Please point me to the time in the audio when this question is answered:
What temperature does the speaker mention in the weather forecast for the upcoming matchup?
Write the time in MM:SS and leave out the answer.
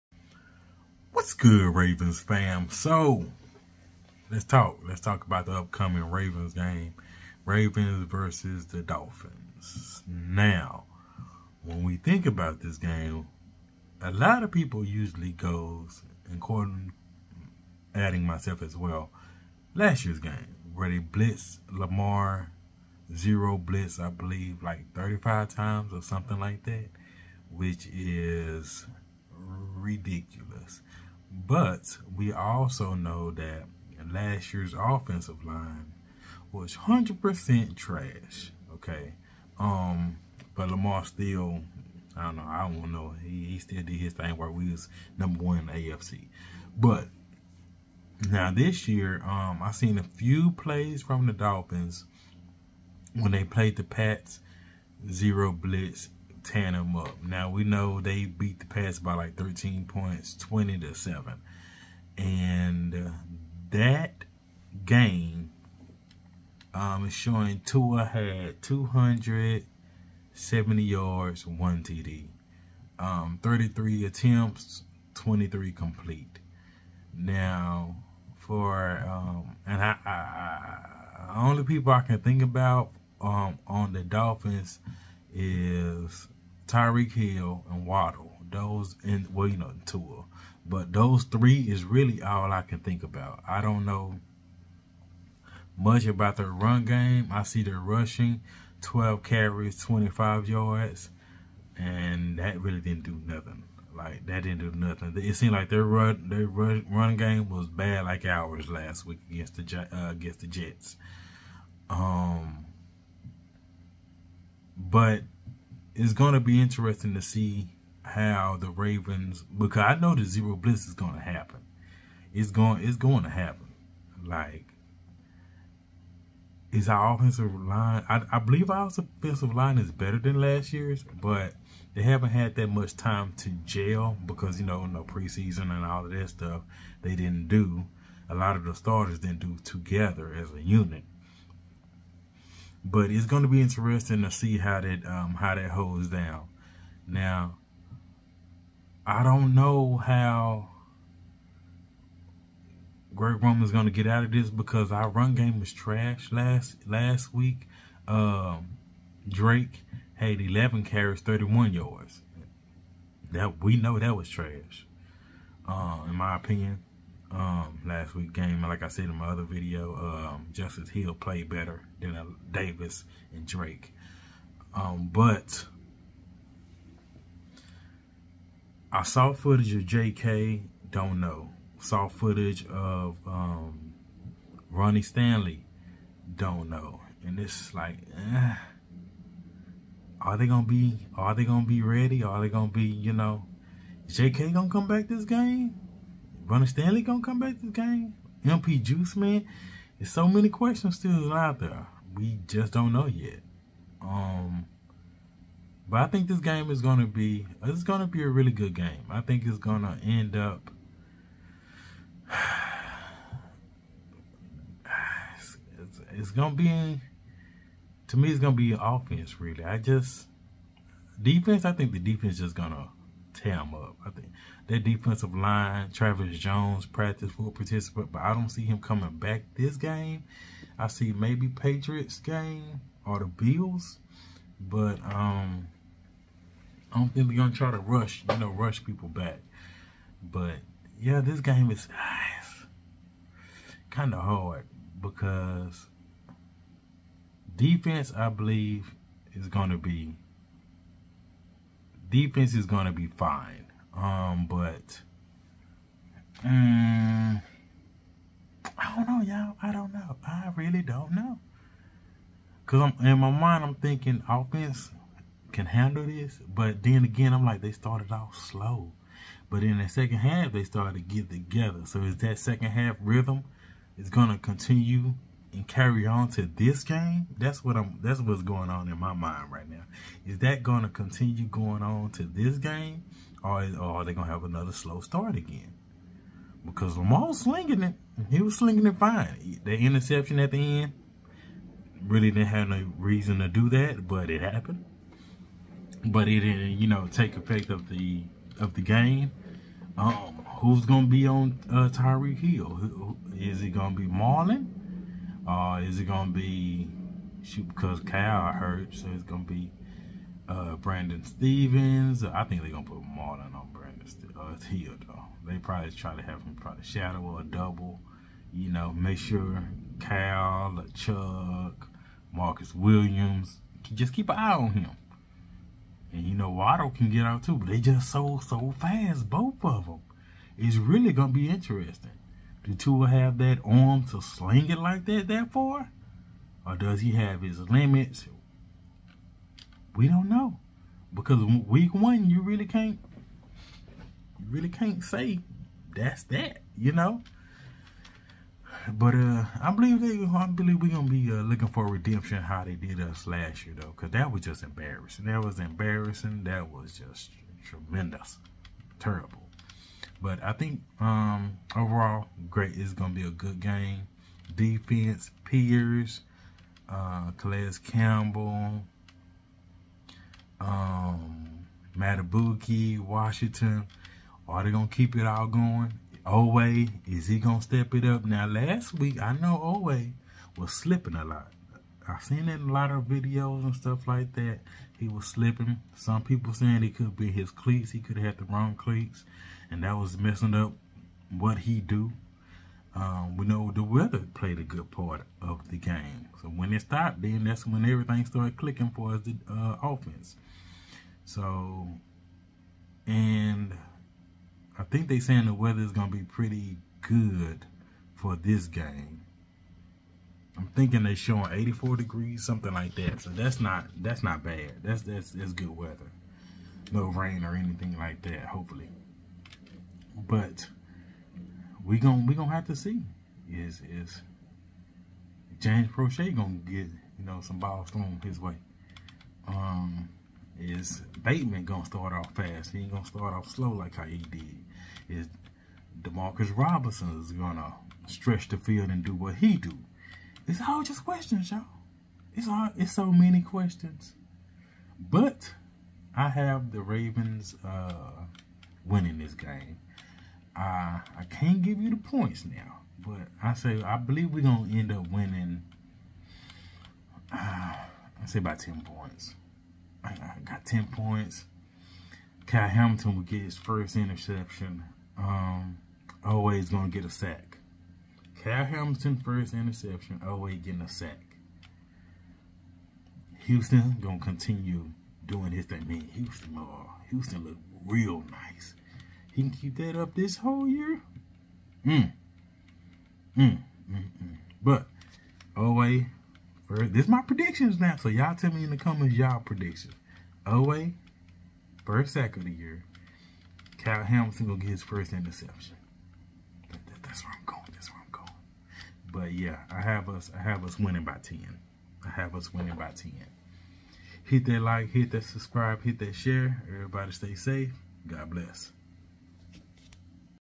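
06:51.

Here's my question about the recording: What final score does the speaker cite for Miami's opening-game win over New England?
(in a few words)
20 to 7.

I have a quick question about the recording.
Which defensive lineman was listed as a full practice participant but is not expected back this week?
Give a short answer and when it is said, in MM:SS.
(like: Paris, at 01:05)
Travis Jones, at 03:45.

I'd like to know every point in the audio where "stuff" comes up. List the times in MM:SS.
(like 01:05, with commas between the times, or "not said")
02:16, 06:23.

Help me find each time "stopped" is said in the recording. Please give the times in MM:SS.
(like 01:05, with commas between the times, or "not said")
06:36.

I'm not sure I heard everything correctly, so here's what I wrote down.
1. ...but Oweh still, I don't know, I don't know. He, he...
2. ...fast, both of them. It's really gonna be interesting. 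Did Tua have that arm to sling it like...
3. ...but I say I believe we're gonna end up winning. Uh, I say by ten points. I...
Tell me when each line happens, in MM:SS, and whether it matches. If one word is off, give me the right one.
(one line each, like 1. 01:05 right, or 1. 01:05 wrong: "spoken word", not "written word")
1. 00:40 wrong: "Lamar", not "Oweh"
2. 05:28 right
3. 07:32 right.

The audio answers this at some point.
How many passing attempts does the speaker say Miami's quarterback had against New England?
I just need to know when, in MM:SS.
01:13.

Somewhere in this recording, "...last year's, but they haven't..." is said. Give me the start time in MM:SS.
02:10.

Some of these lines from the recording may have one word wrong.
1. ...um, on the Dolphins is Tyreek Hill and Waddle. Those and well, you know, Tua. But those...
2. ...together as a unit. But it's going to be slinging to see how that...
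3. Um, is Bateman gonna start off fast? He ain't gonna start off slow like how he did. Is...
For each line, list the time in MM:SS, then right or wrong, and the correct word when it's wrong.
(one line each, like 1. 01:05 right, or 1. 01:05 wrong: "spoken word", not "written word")
1. 01:23 right
2. 02:19 wrong: "interesting", not "slinging"
3. 07:09 right.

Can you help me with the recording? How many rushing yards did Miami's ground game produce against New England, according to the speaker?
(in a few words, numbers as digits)
25 yards.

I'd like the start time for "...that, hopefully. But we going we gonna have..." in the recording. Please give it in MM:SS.
06:58.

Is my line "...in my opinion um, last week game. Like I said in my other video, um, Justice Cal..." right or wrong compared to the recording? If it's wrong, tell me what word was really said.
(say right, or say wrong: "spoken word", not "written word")
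wrong: "Hill", not "Cal".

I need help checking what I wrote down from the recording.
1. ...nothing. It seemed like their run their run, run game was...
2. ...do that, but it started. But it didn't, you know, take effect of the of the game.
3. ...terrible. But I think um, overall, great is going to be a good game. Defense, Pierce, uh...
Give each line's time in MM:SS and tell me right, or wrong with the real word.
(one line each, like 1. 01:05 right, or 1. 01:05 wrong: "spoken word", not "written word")
1. 01:44 right
2. 04:53 wrong: "happened", not "started"
3. 05:58 right.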